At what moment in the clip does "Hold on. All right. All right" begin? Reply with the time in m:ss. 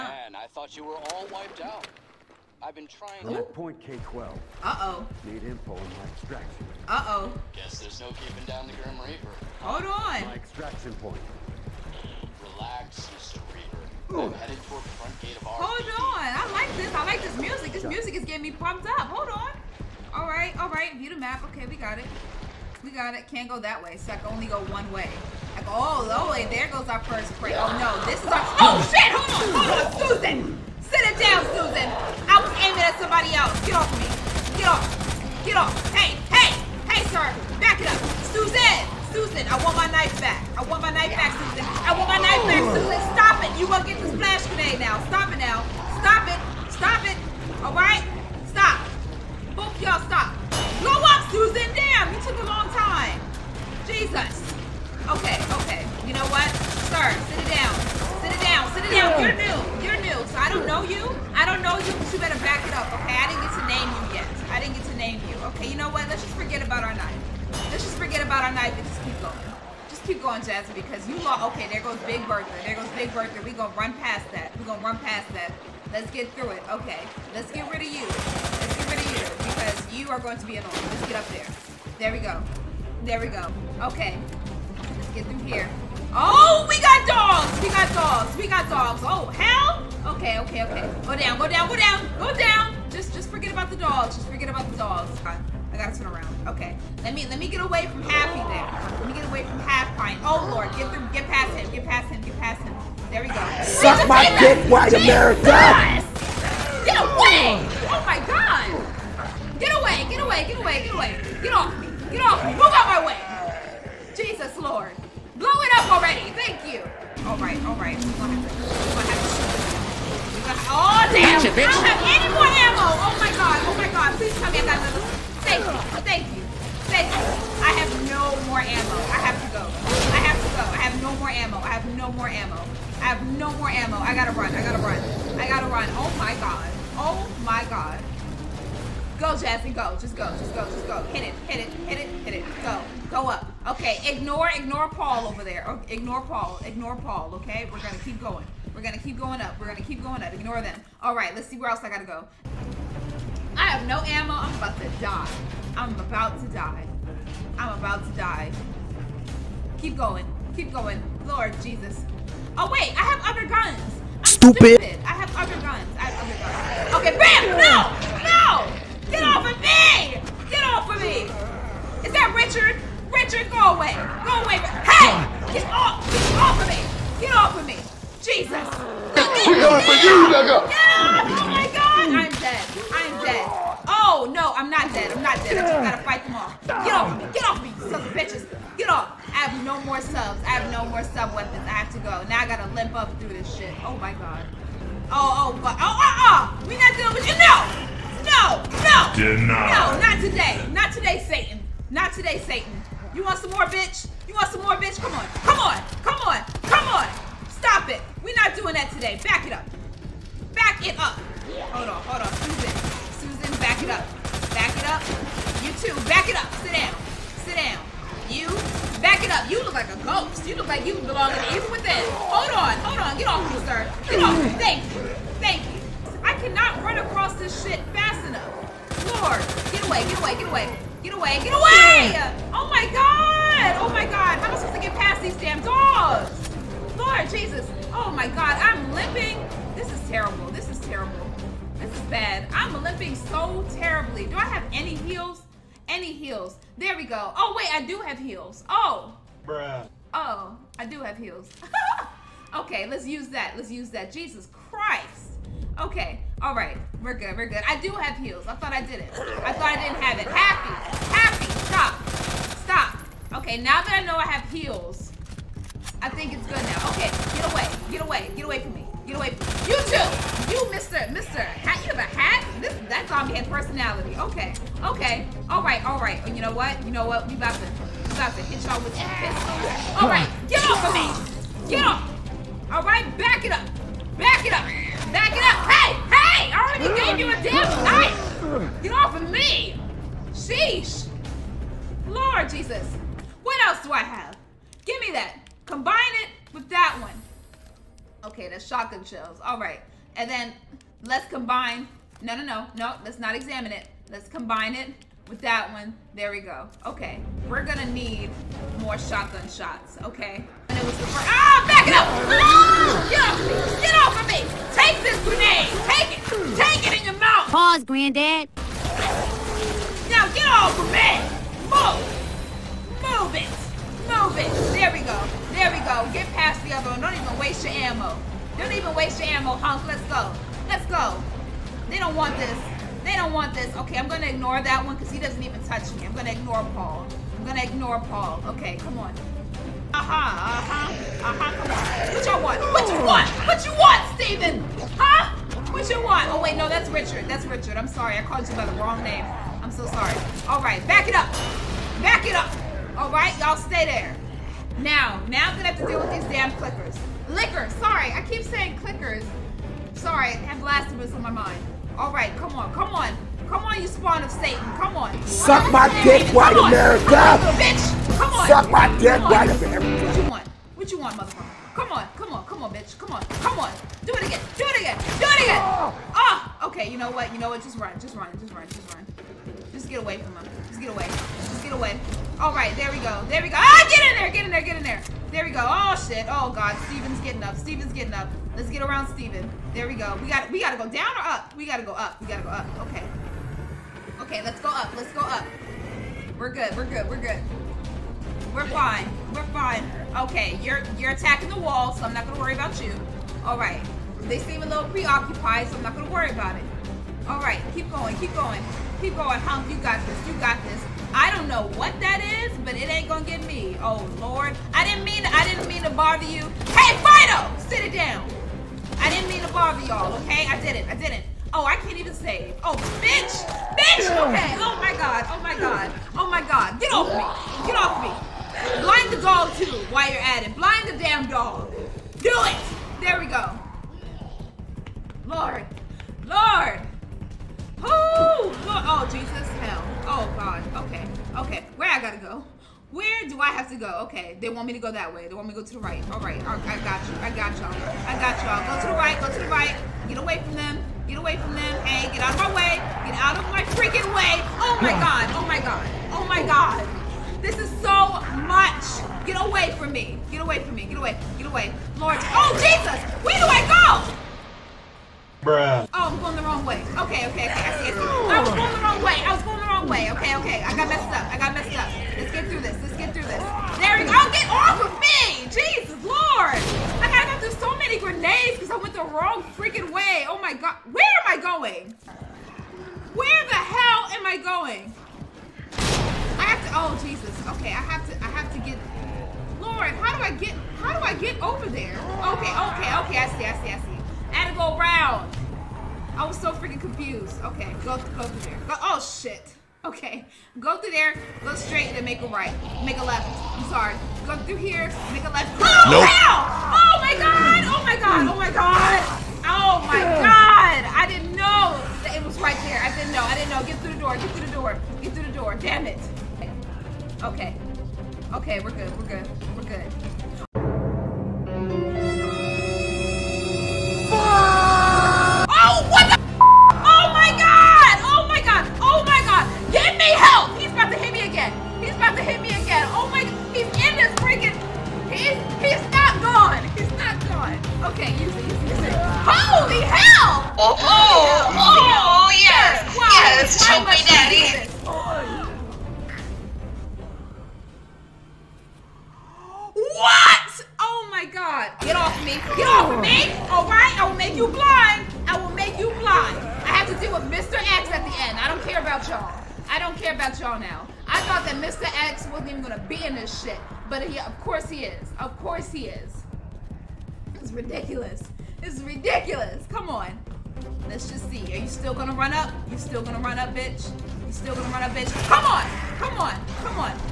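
0:19.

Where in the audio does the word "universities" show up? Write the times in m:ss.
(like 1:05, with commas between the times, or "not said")
not said.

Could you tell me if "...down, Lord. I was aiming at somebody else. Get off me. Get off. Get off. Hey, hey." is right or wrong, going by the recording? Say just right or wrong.
wrong.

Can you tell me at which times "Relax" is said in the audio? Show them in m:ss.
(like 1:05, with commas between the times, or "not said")
0:12.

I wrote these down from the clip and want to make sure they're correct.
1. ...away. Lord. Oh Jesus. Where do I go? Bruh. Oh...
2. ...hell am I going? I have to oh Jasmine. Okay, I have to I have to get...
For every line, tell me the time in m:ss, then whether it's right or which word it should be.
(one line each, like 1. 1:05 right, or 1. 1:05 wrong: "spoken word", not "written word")
1. 7:41 right
2. 8:03 wrong: "Jesus", not "Jasmine".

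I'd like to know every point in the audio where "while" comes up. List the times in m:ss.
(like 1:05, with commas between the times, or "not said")
7:09.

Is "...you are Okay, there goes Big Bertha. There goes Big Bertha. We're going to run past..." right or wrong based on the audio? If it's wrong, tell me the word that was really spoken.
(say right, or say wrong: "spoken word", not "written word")
right.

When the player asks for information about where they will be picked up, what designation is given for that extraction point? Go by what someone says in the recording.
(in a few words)
Point K-12.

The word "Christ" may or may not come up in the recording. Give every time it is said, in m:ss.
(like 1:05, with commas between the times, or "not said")
4:14.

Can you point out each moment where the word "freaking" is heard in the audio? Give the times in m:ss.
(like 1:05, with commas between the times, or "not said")
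7:33, 7:59, 8:16.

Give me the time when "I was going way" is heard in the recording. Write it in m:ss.
7:49.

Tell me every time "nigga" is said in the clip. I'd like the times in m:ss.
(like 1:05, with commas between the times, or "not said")
3:00.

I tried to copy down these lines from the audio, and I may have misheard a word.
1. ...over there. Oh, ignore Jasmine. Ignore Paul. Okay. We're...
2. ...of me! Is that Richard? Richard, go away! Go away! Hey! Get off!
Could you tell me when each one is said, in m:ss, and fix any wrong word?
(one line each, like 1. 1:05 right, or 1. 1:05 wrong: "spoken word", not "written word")
1. 2:25 wrong: "Paul", not "Jasmine"
2. 2:50 right.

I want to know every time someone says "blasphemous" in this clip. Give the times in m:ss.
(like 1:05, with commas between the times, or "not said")
6:00.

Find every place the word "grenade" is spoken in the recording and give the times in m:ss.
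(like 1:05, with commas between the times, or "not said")
0:44, 5:15, 7:57.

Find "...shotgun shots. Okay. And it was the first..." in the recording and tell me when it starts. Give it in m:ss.
5:08.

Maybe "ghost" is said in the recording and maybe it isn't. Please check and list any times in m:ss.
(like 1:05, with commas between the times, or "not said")
3:40.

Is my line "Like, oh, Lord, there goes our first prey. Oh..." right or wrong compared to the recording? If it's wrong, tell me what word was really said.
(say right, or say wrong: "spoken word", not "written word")
right.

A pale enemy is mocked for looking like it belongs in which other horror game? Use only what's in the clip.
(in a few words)
The Evil Within.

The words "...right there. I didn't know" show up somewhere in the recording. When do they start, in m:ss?
8:32.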